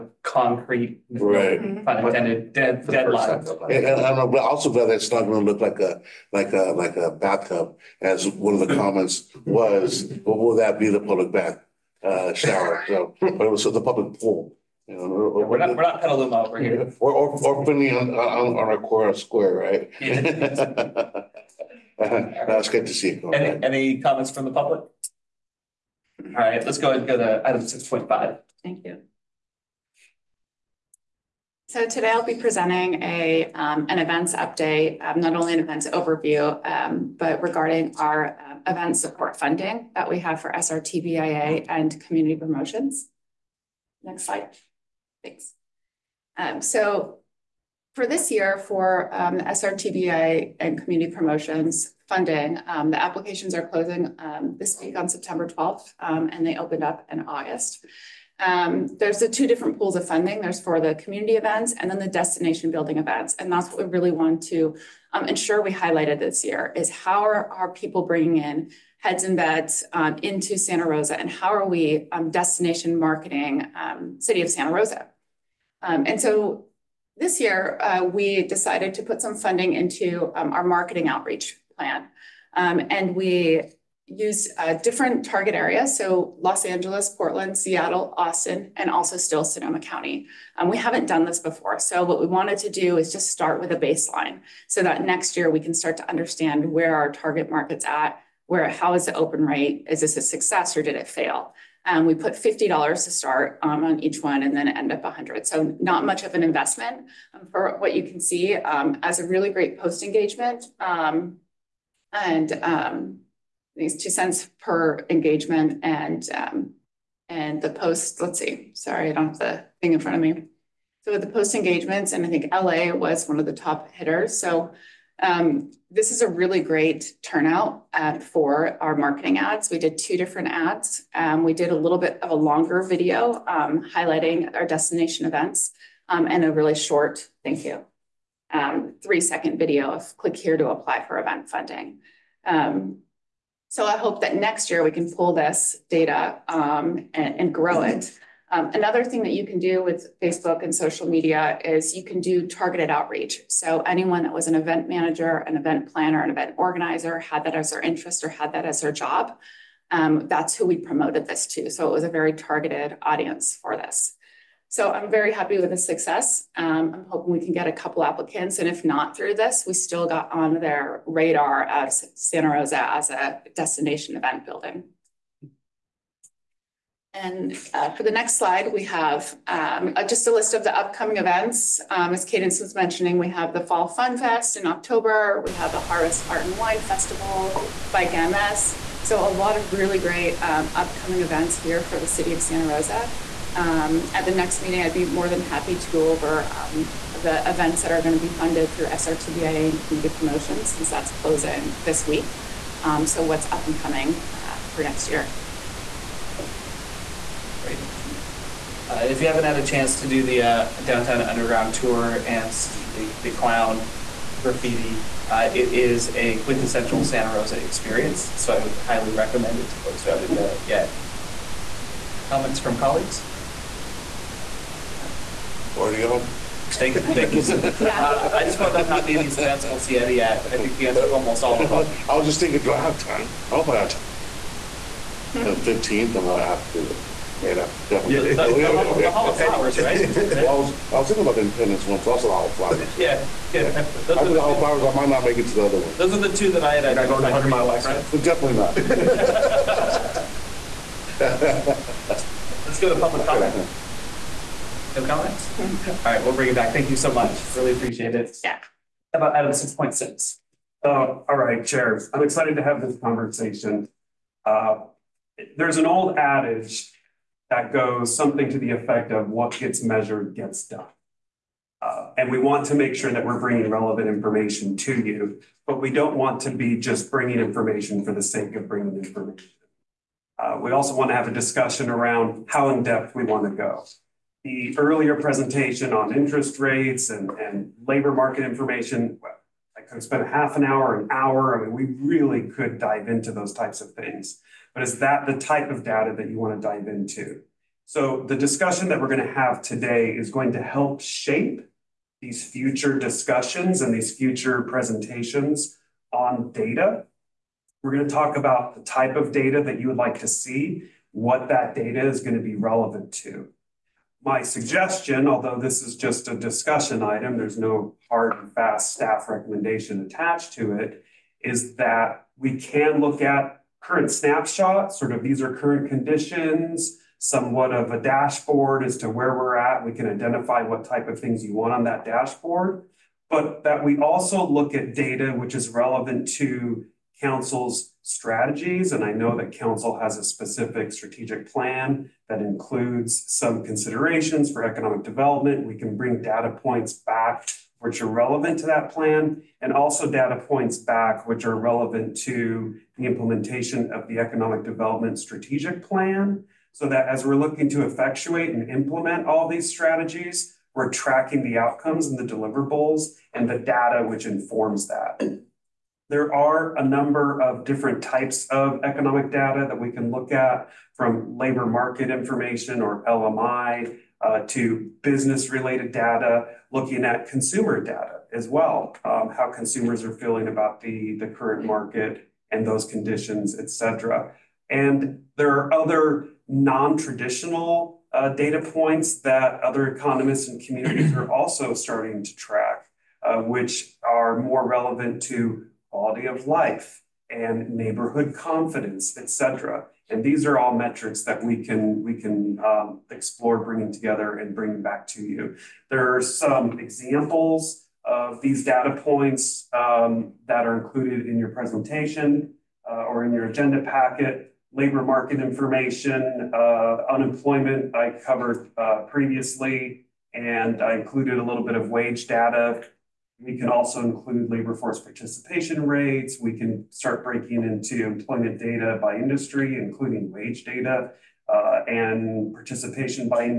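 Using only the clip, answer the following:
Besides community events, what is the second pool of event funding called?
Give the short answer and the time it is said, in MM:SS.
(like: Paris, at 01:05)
destination building events, at 01:02.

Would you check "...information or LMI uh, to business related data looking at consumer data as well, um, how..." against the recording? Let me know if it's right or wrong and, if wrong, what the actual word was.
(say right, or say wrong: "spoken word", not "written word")
right.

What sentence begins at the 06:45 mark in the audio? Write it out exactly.
There are some examples of these data points um, that are included in your presentation uh, or in your agenda packet.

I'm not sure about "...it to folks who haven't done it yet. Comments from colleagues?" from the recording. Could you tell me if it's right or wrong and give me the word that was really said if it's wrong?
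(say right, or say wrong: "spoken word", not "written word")
right.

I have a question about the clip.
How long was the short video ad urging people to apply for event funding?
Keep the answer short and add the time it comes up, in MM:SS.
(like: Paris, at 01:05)
three second, at 02:19.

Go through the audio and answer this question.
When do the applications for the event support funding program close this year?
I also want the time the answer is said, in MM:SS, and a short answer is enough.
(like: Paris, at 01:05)
September 12th, at 00:55.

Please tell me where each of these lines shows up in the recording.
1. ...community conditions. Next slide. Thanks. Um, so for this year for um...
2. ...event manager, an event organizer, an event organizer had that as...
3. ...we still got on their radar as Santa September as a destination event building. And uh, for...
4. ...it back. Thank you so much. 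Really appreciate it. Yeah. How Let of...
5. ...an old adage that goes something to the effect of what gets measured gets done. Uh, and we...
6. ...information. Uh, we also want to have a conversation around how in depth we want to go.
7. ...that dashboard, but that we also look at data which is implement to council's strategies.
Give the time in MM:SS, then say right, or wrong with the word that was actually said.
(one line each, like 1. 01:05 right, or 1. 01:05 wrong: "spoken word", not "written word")
1. 00:42 wrong: "promotions", not "conditions"
2. 02:34 wrong: "planner", not "organizer"
3. 02:49 wrong: "Rosa", not "September"
4. 04:16 wrong: "About", not "Let"
5. 04:25 right
6. 04:38 wrong: "discussion", not "conversation"
7. 05:31 wrong: "relevant", not "implement".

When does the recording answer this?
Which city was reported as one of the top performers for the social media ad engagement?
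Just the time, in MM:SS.
02:02.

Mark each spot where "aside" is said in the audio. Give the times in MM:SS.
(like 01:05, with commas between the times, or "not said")
not said.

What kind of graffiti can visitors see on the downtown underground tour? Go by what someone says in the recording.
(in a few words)
clown graffiti.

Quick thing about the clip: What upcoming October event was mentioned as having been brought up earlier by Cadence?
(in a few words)
Fall Fun Fest.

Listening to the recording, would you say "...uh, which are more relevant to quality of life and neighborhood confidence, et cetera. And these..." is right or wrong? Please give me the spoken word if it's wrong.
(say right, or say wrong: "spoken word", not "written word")
right.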